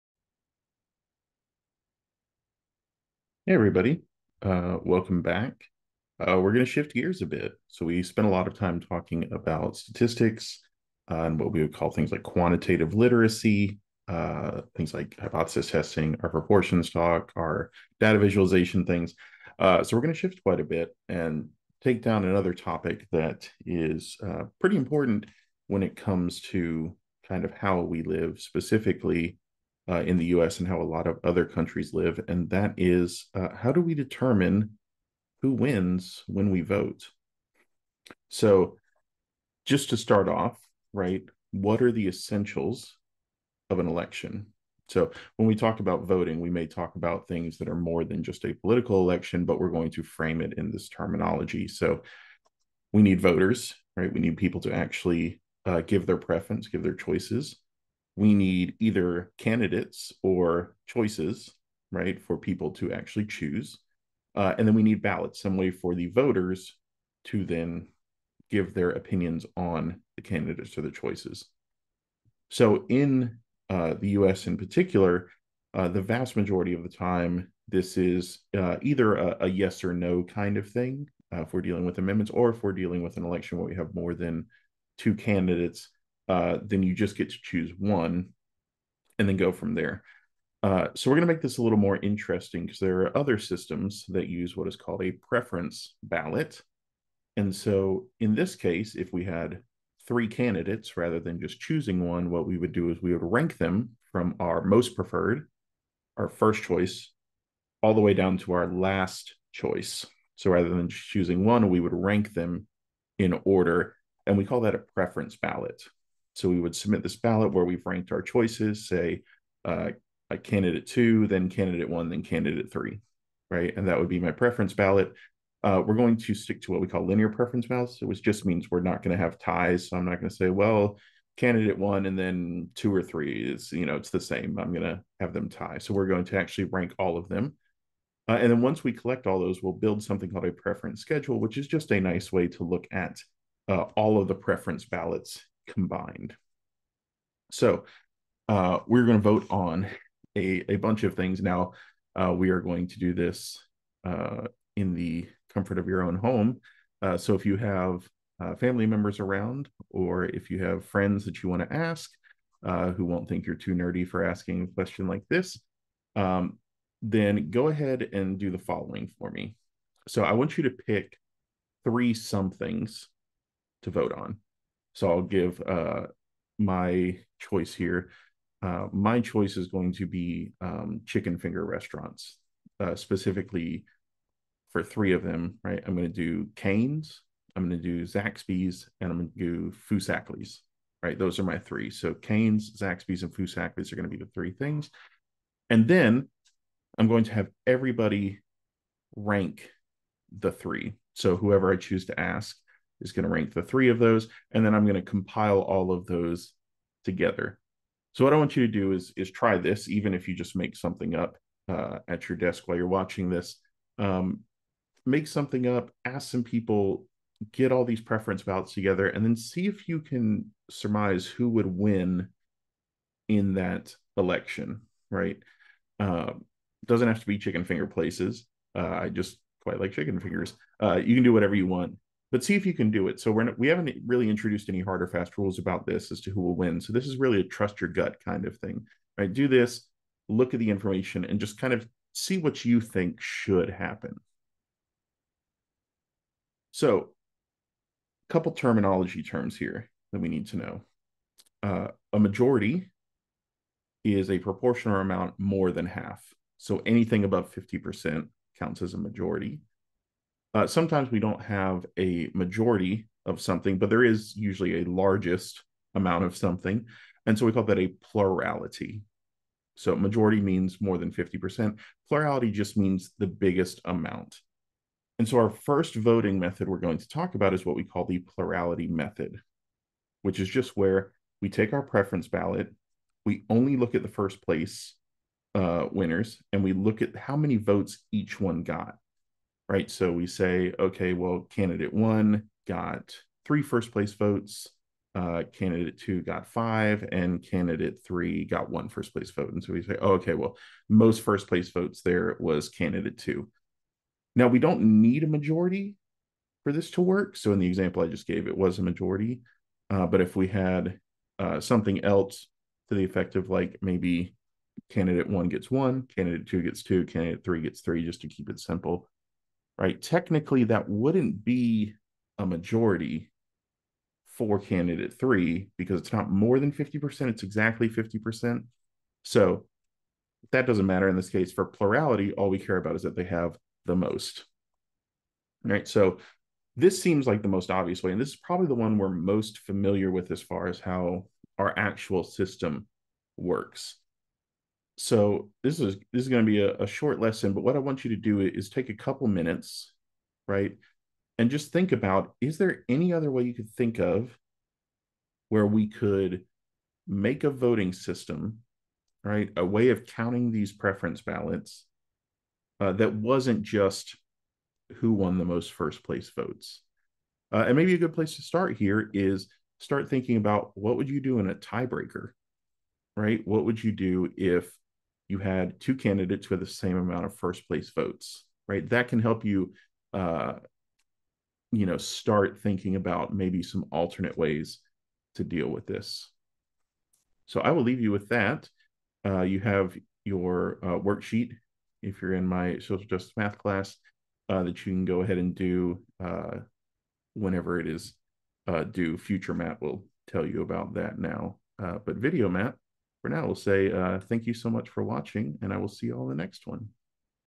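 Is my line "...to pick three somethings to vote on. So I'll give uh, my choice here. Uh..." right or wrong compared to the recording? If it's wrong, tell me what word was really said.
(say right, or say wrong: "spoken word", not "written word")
right.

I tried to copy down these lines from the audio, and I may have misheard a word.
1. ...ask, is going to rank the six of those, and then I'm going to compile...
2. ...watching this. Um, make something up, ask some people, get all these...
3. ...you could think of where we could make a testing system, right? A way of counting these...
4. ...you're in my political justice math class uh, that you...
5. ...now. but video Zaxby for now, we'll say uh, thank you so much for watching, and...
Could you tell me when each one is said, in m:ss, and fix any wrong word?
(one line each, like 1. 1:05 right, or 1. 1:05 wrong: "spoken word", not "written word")
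1. 3:22 wrong: "three", not "six"
2. 3:32 right
3. 5:53 wrong: "voting", not "testing"
4. 6:32 wrong: "social", not "political"
5. 6:41 wrong: "Matt", not "Zaxby".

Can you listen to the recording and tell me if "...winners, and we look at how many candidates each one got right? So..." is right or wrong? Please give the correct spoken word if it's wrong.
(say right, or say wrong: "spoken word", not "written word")
wrong: "votes", not "candidates".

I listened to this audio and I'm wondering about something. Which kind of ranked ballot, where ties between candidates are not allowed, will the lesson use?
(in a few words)
linear preference ballots.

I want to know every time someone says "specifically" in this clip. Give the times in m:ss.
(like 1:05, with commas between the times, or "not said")
0:28, 3:02.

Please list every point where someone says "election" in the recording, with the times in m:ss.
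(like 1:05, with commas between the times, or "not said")
0:43, 0:49, 1:23, 3:44.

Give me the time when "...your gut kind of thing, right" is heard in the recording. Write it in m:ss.
3:57.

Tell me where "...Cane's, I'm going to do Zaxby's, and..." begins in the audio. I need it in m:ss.
3:06.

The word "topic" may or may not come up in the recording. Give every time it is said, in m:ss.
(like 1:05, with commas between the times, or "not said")
0:22.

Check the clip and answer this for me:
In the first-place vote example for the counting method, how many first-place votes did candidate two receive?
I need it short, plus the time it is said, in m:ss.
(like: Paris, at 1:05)
5, at 4:56.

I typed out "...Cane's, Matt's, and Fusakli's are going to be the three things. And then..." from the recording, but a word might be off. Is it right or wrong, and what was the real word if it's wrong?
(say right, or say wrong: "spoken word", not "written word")
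wrong: "Zaxby", not "Matt".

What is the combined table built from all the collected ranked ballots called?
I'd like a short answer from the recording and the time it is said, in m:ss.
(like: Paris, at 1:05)
preference schedule, at 2:20.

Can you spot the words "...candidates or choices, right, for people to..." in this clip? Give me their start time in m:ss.
0:59.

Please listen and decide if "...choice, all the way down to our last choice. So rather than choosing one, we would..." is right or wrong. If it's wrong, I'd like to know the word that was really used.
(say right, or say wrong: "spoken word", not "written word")
right.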